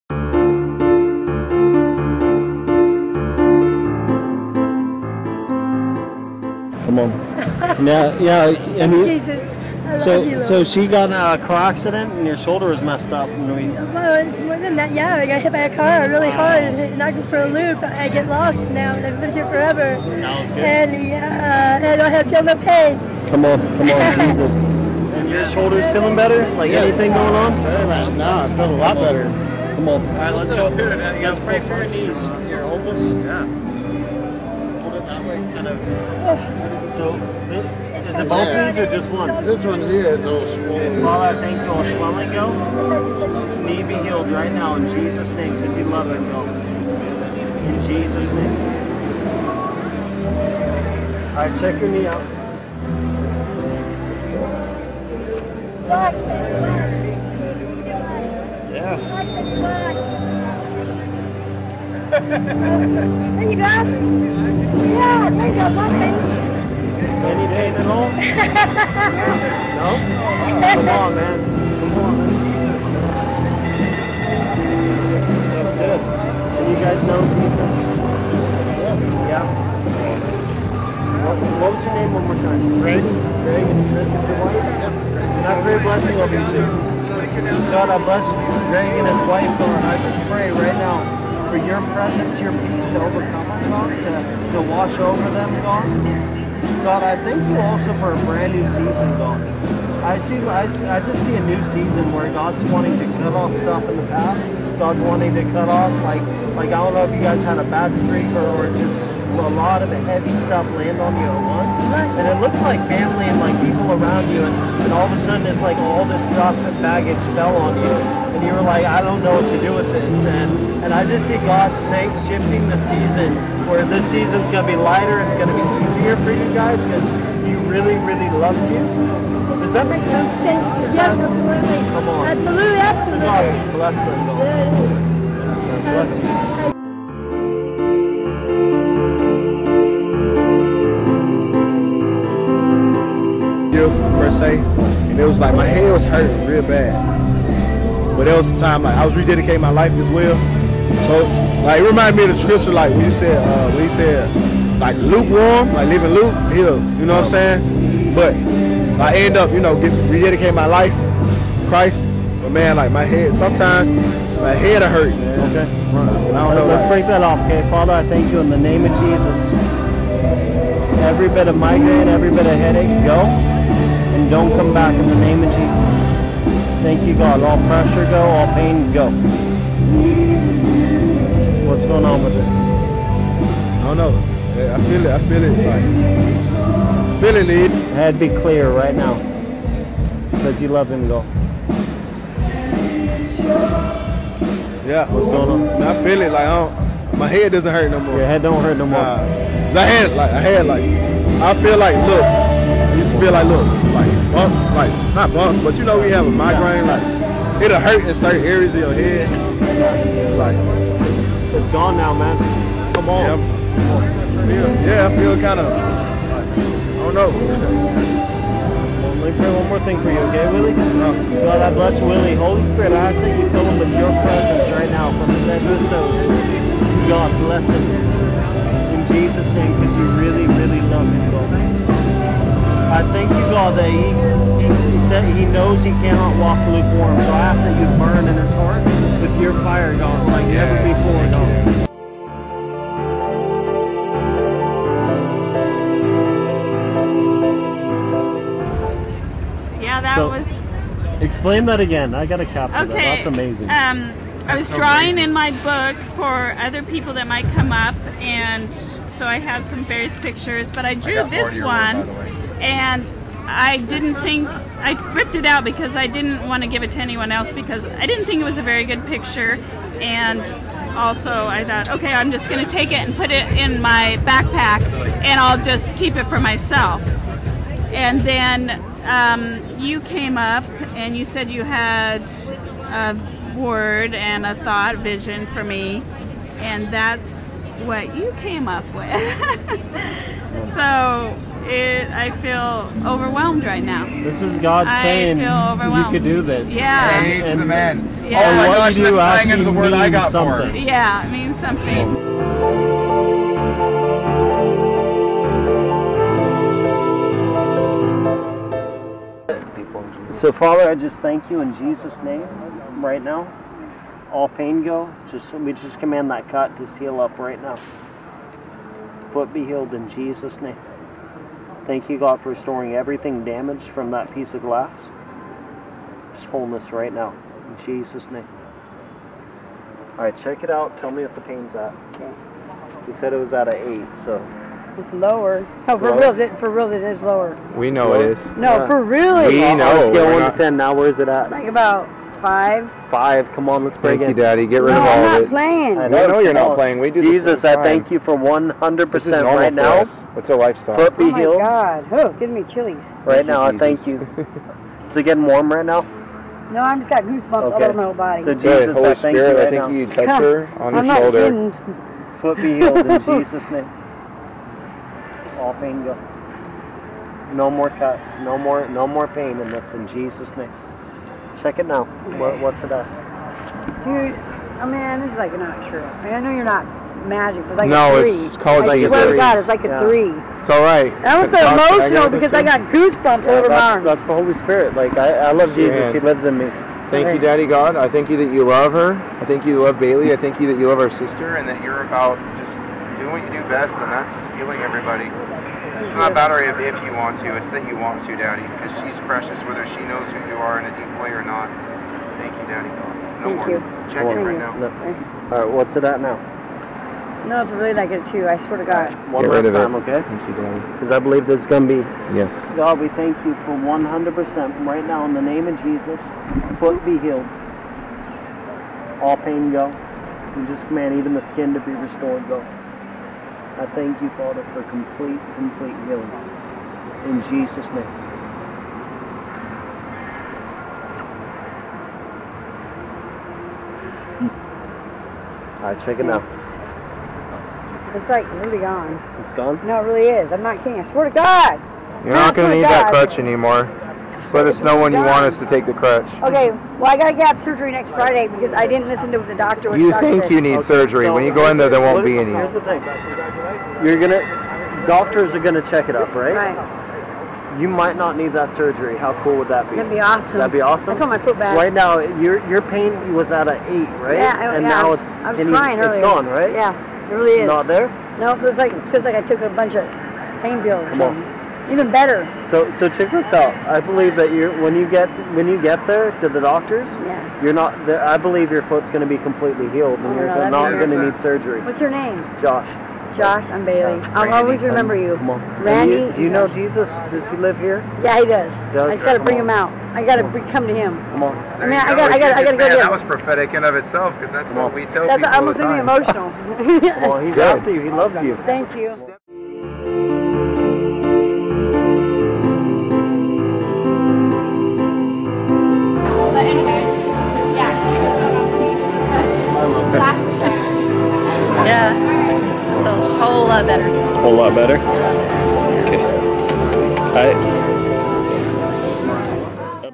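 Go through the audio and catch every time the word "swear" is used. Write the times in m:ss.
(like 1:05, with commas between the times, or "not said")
6:19, 6:48, 7:21.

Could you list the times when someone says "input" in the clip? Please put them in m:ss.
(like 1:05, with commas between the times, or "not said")
not said.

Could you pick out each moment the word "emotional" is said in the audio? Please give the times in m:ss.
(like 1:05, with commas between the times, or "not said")
6:21, 8:16.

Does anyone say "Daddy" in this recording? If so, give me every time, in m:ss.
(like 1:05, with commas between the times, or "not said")
5:44, 6:27, 6:38, 6:42, 6:50.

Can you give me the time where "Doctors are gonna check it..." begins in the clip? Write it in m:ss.
7:35.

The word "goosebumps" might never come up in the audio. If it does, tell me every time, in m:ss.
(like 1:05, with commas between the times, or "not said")
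5:57, 6:22.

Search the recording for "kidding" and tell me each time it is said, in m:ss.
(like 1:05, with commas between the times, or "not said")
6:01, 7:20.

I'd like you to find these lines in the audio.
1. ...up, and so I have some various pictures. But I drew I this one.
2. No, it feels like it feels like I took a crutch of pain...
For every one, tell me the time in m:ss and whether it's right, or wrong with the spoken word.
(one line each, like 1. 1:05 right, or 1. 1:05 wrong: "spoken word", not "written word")
1. 4:17 right
2. 7:48 wrong: "bunch", not "crutch".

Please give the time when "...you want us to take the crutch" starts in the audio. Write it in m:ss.
7:25.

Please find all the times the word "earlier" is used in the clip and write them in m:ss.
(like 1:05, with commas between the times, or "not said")
7:46.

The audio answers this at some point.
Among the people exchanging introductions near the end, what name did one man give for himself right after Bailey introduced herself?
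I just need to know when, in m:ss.
8:05.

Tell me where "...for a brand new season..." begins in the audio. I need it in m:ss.
1:37.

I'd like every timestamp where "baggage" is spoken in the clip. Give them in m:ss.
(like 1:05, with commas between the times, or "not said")
1:56.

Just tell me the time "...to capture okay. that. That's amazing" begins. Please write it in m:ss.
4:12.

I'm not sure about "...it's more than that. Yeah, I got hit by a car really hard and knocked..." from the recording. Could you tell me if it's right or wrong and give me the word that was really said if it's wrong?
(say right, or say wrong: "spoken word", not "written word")
right.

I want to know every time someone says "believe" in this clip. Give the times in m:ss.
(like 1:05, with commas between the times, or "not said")
6:51, 7:53, 7:58.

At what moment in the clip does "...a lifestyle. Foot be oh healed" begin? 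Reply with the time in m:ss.
5:50.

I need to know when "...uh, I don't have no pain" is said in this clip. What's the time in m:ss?
0:21.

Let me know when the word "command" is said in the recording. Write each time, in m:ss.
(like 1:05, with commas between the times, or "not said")
5:15, 7:00.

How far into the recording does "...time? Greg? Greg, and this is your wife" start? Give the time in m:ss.
1:22.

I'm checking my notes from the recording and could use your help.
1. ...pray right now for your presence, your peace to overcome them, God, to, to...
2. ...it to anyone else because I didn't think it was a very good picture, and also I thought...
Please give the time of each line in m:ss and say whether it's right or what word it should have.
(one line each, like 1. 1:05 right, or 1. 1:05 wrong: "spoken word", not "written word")
1. 1:30 right
2. 4:26 right.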